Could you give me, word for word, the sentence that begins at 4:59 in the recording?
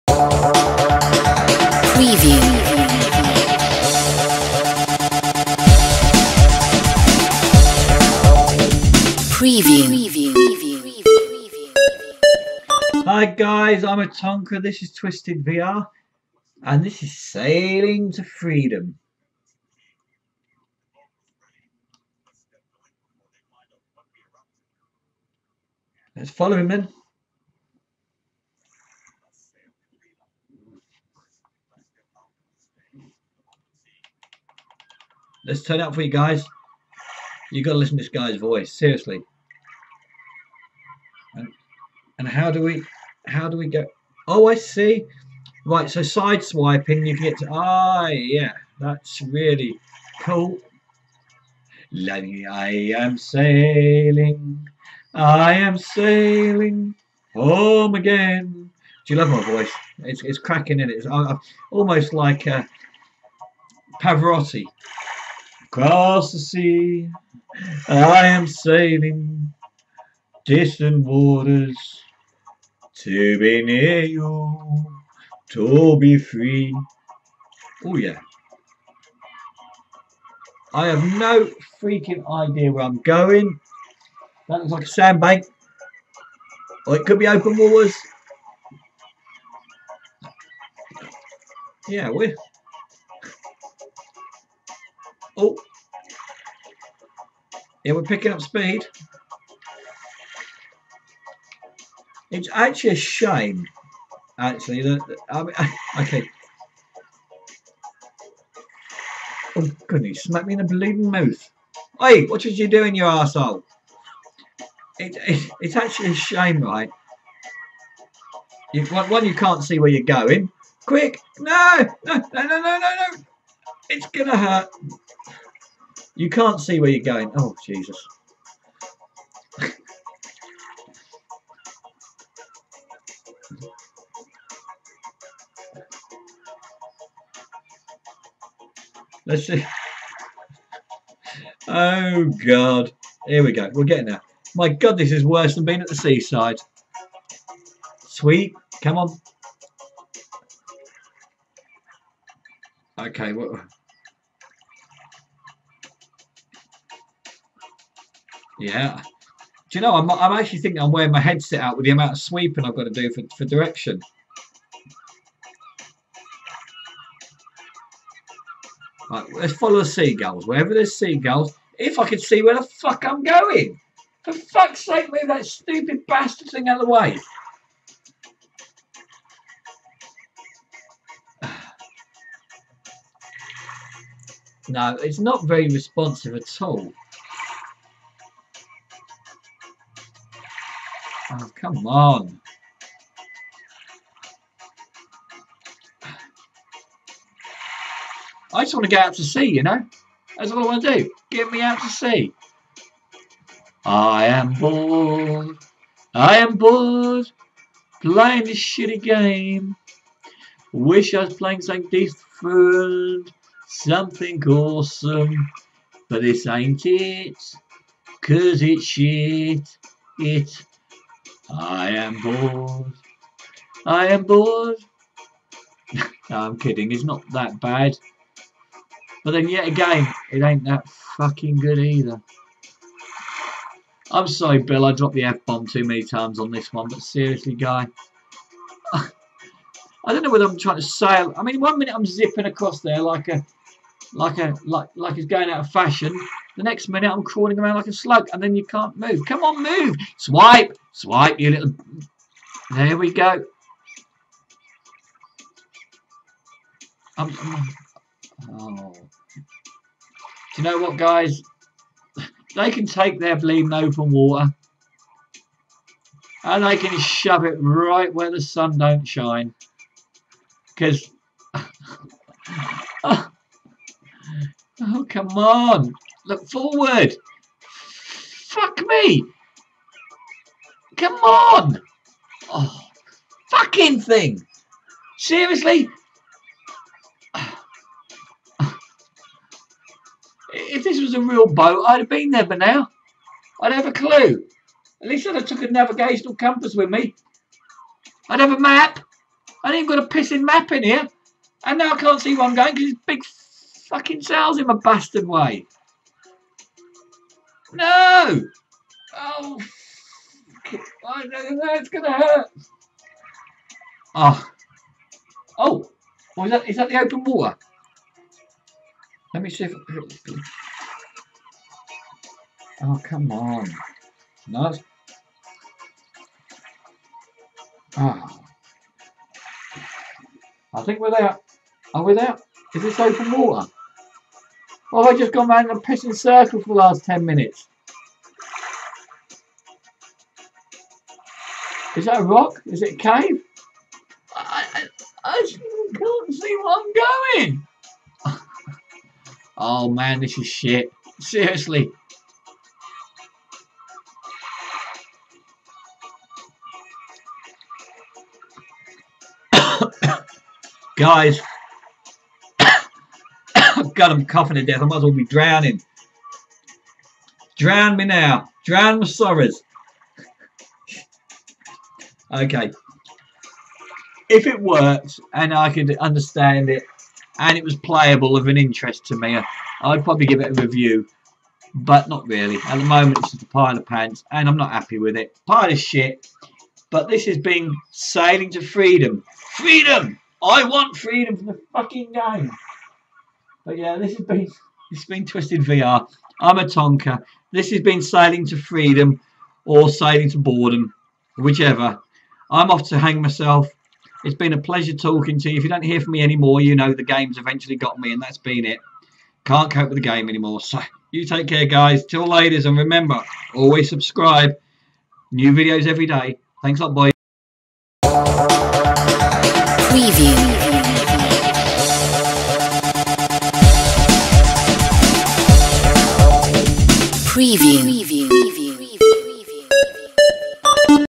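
I ain't got a pissing map in here.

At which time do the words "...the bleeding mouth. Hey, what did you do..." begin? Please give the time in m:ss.
1:50.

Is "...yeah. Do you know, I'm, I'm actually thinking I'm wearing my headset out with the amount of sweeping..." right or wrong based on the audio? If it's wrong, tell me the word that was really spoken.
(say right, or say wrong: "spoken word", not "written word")
right.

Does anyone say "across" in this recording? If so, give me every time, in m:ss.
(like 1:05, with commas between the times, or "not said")
1:05, 4:02.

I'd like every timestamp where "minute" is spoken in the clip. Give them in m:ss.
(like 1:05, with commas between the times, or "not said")
4:01, 4:06, 5:37.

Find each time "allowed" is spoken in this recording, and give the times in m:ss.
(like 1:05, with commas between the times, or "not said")
not said.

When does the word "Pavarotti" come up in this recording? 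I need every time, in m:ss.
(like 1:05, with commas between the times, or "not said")
1:04.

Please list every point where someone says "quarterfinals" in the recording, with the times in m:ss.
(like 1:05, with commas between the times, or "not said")
not said.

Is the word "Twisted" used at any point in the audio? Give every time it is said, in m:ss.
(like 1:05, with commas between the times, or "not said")
0:14, 6:35.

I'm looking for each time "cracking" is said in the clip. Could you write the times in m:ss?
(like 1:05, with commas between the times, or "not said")
1:00.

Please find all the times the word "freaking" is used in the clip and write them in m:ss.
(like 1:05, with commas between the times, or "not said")
1:21.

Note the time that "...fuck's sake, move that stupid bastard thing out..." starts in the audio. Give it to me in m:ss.
2:54.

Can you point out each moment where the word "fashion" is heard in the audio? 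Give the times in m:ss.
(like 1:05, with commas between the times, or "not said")
4:05.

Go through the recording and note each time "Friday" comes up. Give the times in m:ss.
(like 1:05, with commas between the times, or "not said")
not said.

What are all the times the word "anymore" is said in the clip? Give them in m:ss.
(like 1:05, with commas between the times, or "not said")
6:46, 6:50.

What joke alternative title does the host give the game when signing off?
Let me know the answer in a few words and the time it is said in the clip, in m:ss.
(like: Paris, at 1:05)
Sailing to Boredom, at 6:39.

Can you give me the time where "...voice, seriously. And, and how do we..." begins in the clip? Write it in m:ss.
0:38.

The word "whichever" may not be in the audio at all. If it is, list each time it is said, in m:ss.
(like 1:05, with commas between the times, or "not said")
6:41.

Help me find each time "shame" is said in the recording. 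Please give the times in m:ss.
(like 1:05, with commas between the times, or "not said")
1:42, 1:56.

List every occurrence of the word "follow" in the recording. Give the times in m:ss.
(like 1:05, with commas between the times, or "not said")
0:26, 2:49.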